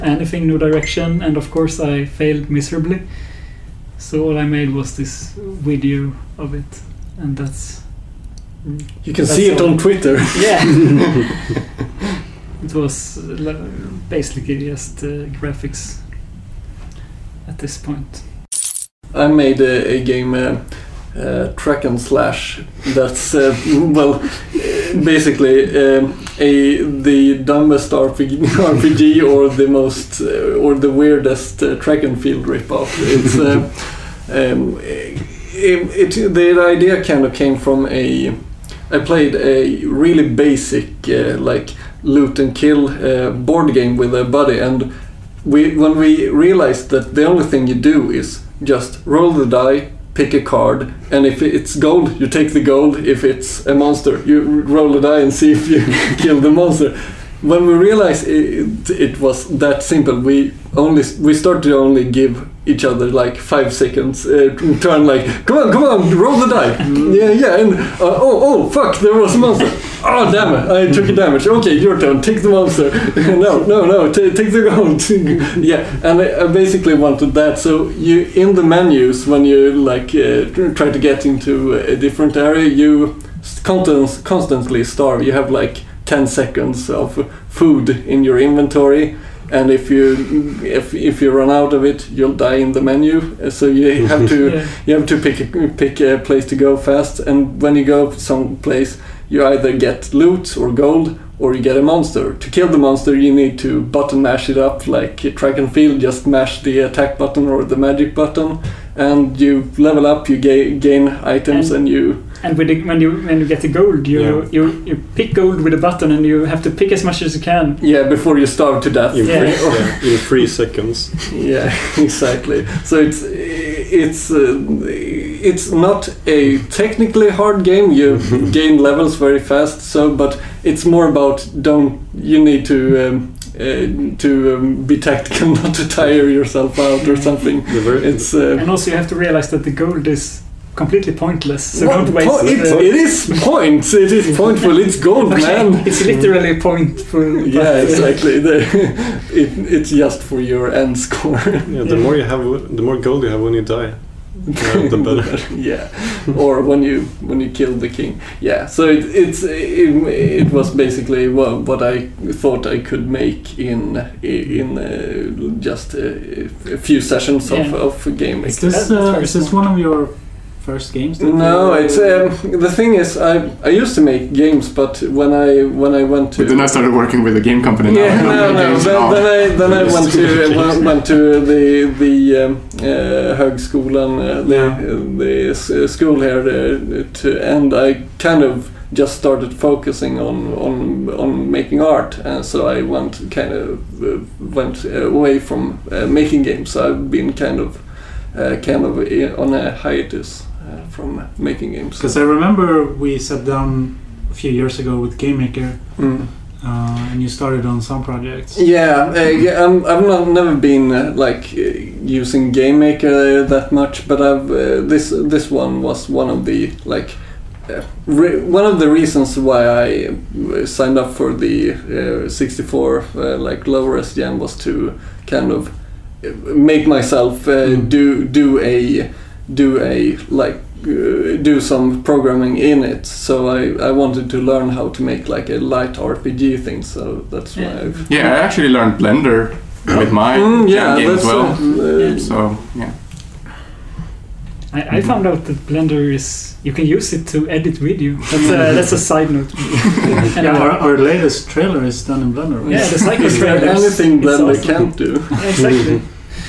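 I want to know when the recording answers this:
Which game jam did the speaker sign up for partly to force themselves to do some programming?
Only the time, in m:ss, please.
3:42.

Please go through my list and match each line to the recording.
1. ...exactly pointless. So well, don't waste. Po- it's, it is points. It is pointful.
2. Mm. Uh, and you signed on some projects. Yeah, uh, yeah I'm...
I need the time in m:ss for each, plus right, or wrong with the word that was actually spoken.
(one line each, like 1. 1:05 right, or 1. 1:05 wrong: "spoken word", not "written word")
1. 2:20 wrong: "completely", not "exactly"
2. 3:25 wrong: "started", not "signed".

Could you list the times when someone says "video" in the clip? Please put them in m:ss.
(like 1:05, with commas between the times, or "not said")
0:05, 4:07.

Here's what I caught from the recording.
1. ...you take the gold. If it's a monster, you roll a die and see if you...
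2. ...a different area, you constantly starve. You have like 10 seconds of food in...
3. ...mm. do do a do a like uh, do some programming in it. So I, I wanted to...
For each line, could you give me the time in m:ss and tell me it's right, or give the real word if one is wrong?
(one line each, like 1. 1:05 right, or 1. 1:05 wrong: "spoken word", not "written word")
1. 0:52 right
2. 1:21 right
3. 3:47 right.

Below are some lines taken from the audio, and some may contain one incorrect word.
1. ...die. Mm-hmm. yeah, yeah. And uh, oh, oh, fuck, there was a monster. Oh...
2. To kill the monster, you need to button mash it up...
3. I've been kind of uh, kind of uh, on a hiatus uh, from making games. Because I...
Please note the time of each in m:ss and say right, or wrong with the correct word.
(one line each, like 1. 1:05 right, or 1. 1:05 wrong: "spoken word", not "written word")
1. 1:06 right
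2. 1:42 right
3. 3:16 right.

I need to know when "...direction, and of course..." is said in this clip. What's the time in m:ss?
0:00.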